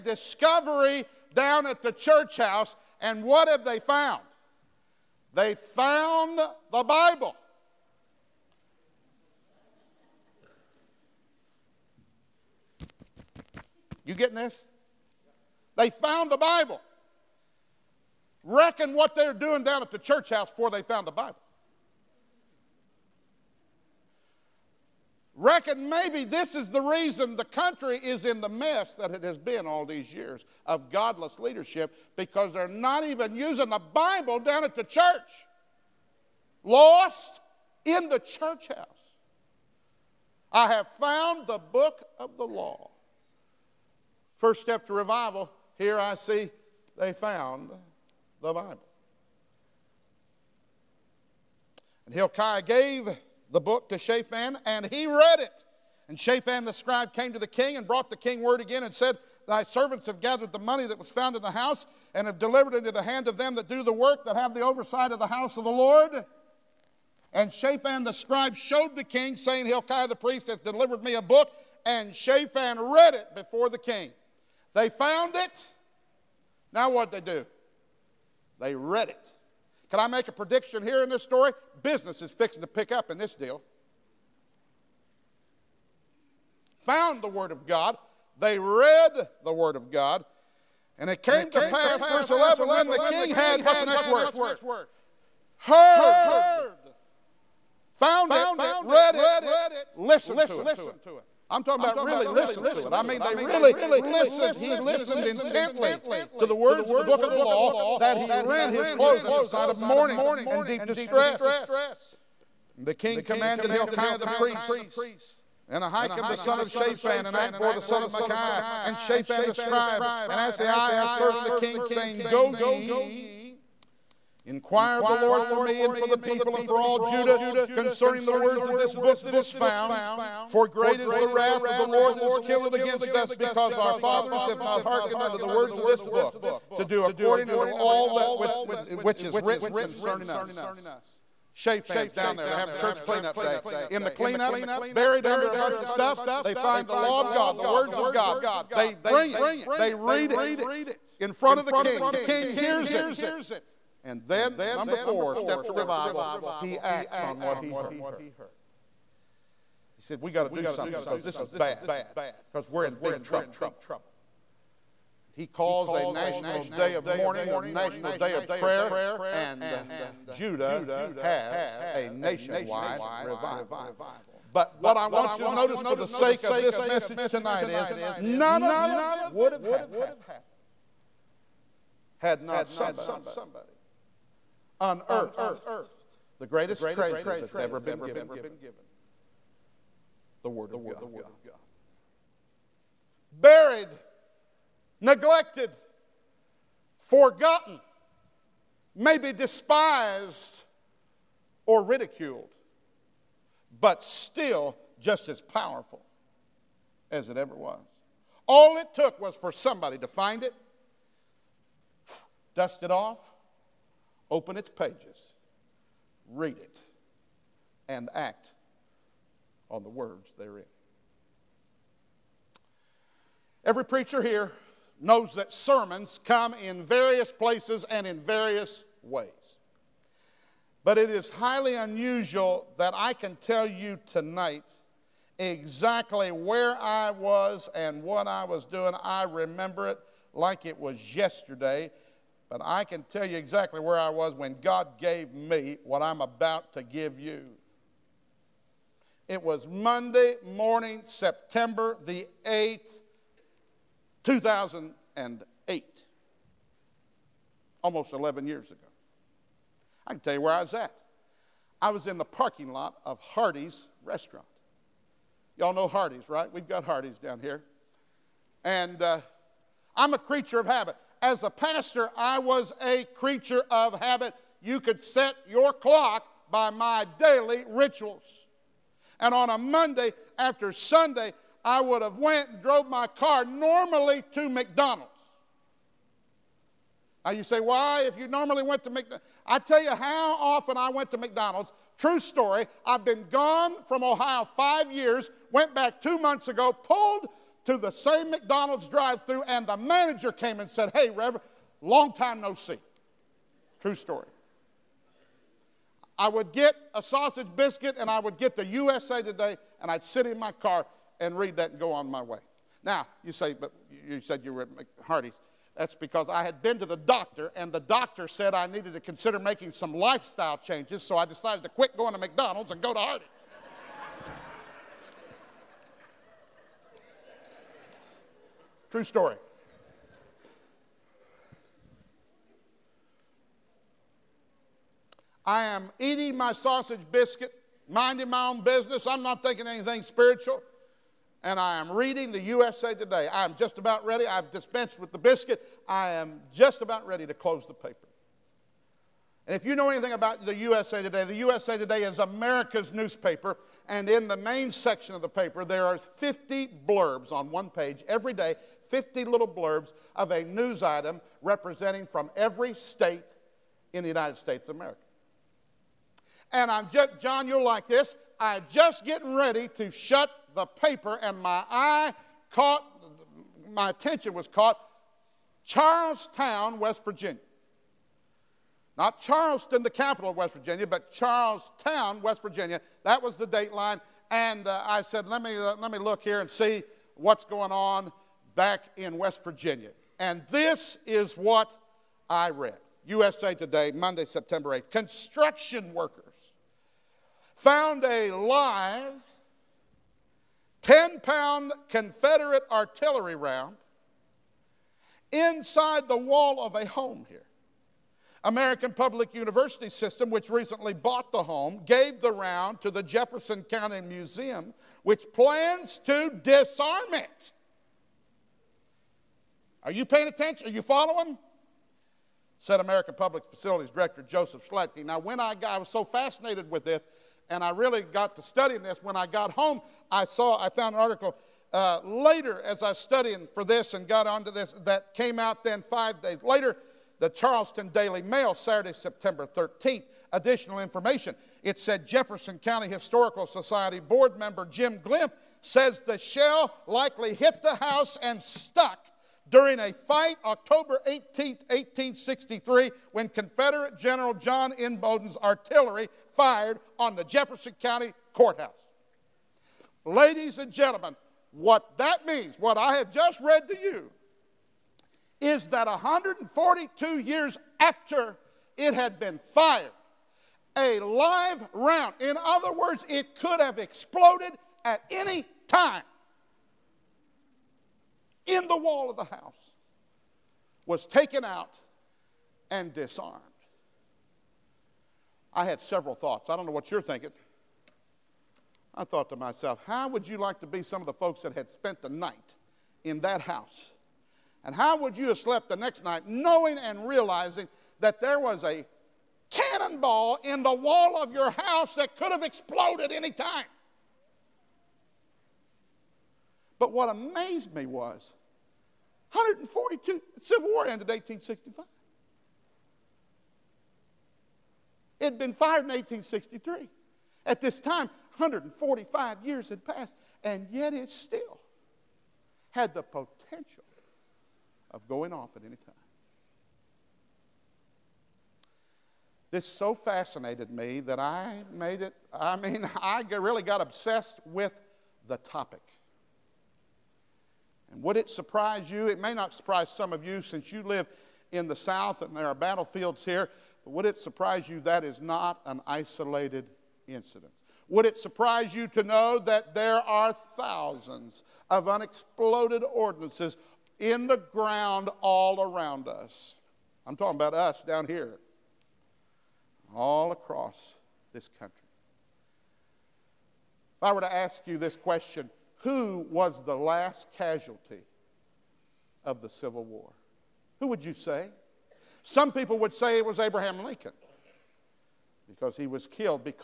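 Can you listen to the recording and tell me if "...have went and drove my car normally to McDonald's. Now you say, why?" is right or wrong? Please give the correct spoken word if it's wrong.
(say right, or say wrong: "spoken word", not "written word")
right.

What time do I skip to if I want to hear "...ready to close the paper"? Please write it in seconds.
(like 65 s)
347 s.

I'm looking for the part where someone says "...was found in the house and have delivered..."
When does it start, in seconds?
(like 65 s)
60 s.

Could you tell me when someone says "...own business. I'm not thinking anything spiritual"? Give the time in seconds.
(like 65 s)
338 s.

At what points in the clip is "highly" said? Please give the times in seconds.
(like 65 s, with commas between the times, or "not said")
231 s.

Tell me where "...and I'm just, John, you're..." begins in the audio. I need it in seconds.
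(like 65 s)
366 s.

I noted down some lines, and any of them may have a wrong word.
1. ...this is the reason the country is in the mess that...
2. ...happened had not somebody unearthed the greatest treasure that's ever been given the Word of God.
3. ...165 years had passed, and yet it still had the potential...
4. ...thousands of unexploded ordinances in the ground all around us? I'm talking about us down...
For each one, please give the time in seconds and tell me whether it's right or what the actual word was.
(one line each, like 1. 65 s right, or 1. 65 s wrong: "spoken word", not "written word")
1. 26 s right
2. 179 s right
3. 518 s wrong: "145", not "165"
4. 550 s right.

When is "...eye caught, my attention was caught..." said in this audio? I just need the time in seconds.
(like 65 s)
371 s.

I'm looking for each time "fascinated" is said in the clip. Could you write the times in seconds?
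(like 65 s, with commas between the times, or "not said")
426 s, 529 s.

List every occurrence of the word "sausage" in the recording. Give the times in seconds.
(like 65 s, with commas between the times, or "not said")
307 s, 336 s.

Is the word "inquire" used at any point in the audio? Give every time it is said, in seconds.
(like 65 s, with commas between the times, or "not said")
124 s.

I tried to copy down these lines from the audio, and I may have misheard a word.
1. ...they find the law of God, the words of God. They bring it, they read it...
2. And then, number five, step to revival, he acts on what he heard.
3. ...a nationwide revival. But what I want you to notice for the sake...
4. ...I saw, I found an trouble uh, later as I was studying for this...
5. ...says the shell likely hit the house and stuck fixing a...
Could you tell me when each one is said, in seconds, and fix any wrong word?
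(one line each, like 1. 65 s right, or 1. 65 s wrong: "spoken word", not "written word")
1. 146 s right
2. 154 s wrong: "four", not "five"
3. 171 s right
4. 430 s wrong: "article", not "trouble"
5. 445 s wrong: "during", not "fixing".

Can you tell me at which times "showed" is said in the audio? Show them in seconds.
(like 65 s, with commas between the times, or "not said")
68 s.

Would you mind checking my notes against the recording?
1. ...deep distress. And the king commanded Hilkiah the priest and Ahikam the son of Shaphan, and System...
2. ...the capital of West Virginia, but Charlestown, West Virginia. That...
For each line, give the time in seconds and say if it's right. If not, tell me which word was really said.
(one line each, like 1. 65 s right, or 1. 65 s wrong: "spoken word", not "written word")
1. 110 s wrong: "Achbor", not "System"
2. 379 s right.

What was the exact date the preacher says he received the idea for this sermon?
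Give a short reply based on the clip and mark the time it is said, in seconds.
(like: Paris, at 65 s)
September 8, 2008, at 251 s.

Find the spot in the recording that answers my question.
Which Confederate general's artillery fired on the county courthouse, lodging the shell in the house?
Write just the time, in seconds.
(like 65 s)
454 s.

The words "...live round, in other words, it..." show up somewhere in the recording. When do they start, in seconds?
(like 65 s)
470 s.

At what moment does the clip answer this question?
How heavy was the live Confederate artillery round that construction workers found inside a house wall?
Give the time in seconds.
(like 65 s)
400 s.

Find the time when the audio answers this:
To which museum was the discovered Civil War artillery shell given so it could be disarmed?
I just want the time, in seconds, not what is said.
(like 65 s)
413 s.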